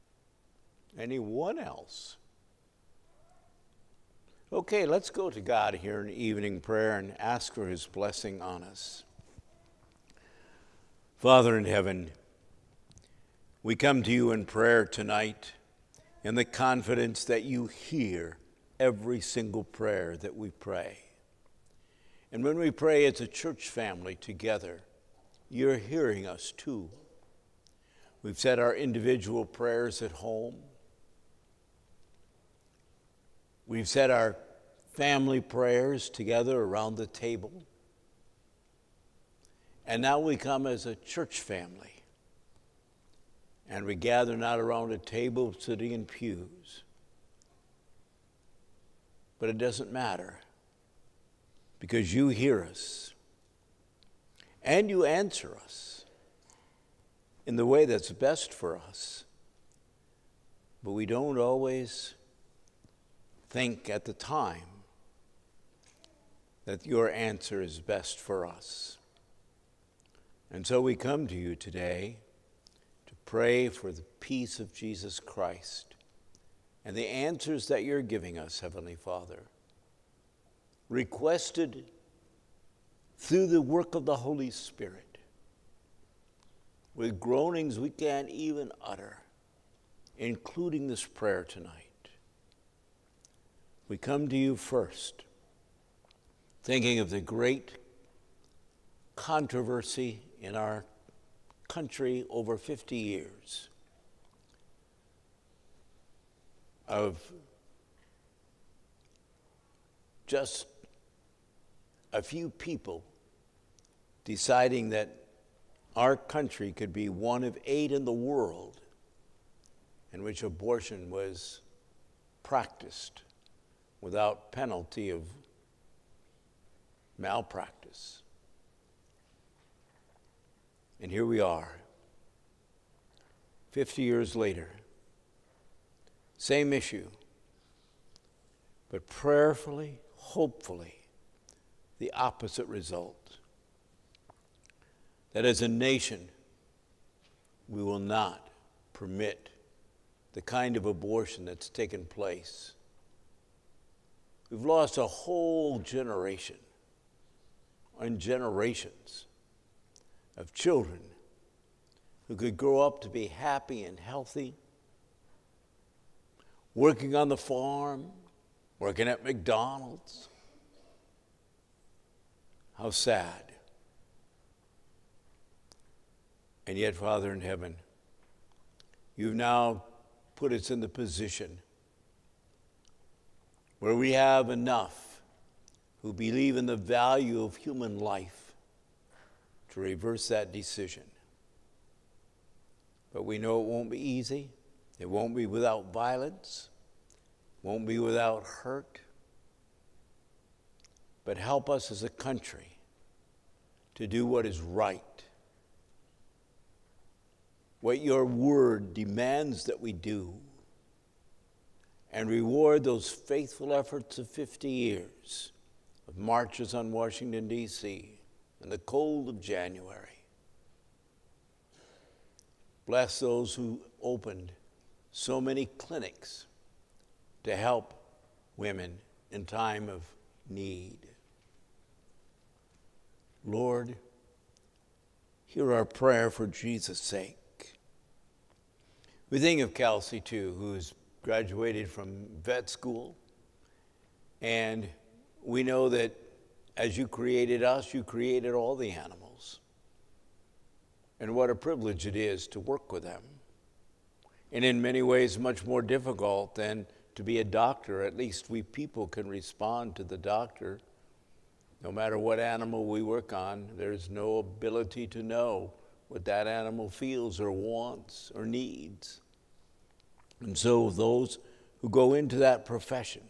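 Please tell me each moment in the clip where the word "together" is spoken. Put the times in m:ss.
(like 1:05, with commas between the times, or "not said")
0:24, 0:36.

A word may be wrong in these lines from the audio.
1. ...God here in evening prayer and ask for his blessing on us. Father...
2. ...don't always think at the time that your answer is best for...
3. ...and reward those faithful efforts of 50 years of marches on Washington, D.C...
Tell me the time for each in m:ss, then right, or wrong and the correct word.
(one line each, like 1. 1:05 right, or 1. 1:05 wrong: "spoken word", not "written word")
1. 0:05 right
2. 1:01 right
3. 3:32 right.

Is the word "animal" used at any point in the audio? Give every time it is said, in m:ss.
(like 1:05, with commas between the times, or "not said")
4:08, 4:22, 4:26.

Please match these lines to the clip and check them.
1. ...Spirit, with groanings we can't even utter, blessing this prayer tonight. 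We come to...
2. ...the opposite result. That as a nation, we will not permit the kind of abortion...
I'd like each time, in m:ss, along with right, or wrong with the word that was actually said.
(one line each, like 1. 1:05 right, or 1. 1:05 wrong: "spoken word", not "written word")
1. 1:24 wrong: "including", not "blessing"
2. 2:21 right.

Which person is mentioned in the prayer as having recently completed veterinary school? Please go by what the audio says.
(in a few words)
Kelsey.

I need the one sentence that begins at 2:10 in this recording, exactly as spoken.
And here we are, 50 years later.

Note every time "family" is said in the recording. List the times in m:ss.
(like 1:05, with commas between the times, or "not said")
0:23, 0:34, 0:41.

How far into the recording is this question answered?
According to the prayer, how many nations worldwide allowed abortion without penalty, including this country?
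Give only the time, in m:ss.
1:57.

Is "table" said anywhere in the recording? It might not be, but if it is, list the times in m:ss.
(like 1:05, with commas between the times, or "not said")
0:37, 0:44.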